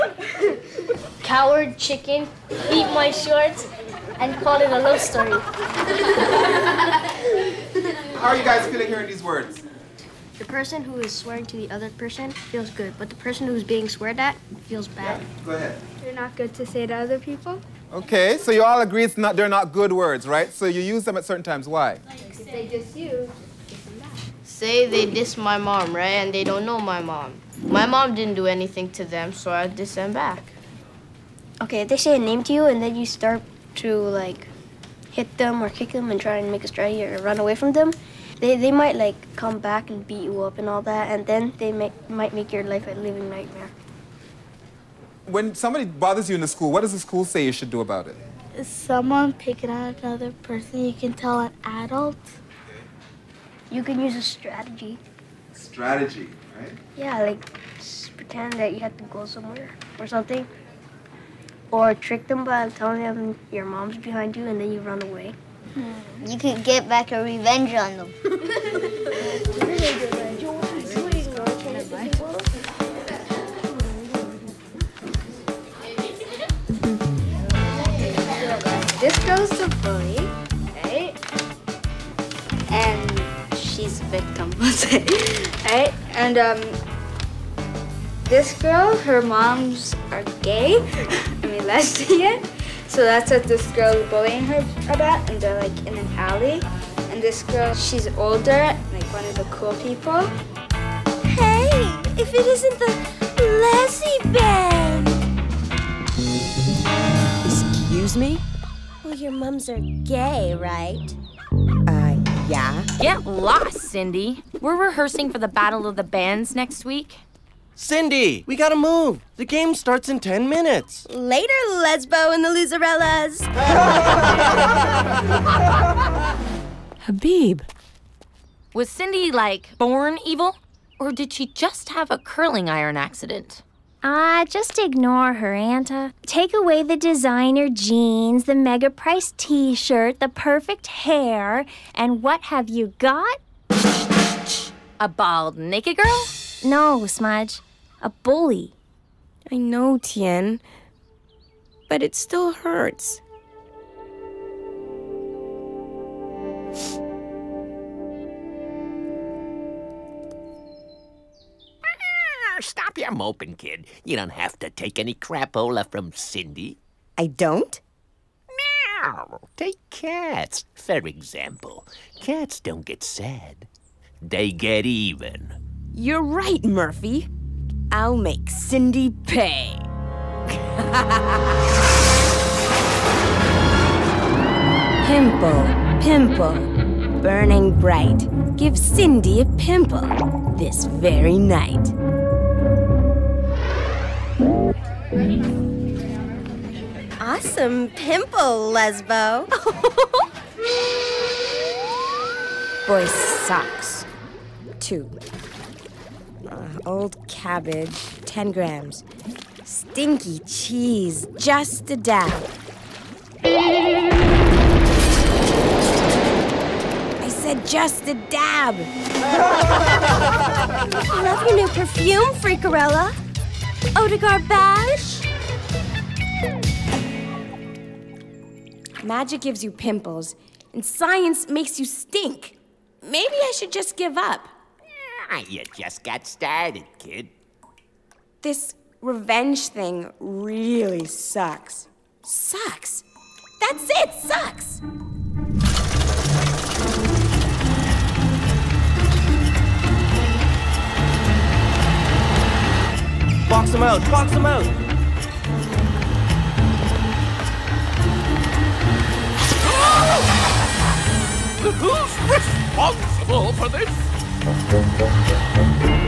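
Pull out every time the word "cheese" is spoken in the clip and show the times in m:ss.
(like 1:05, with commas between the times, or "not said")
3:30.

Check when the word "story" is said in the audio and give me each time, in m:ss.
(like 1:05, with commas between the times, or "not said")
0:04.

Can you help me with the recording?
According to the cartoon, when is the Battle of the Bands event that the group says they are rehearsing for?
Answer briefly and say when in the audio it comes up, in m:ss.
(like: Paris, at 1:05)
next week, at 1:56.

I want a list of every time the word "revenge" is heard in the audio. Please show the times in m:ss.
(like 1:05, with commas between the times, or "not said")
1:07, 3:59.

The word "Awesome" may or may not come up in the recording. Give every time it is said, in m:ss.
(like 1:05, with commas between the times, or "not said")
3:17.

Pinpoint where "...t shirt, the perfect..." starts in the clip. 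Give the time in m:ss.
2:19.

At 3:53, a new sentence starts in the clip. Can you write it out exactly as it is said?
Maybe I should just give up.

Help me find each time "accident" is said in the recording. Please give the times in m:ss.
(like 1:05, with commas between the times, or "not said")
2:12.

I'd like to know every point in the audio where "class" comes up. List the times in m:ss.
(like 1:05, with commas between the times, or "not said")
not said.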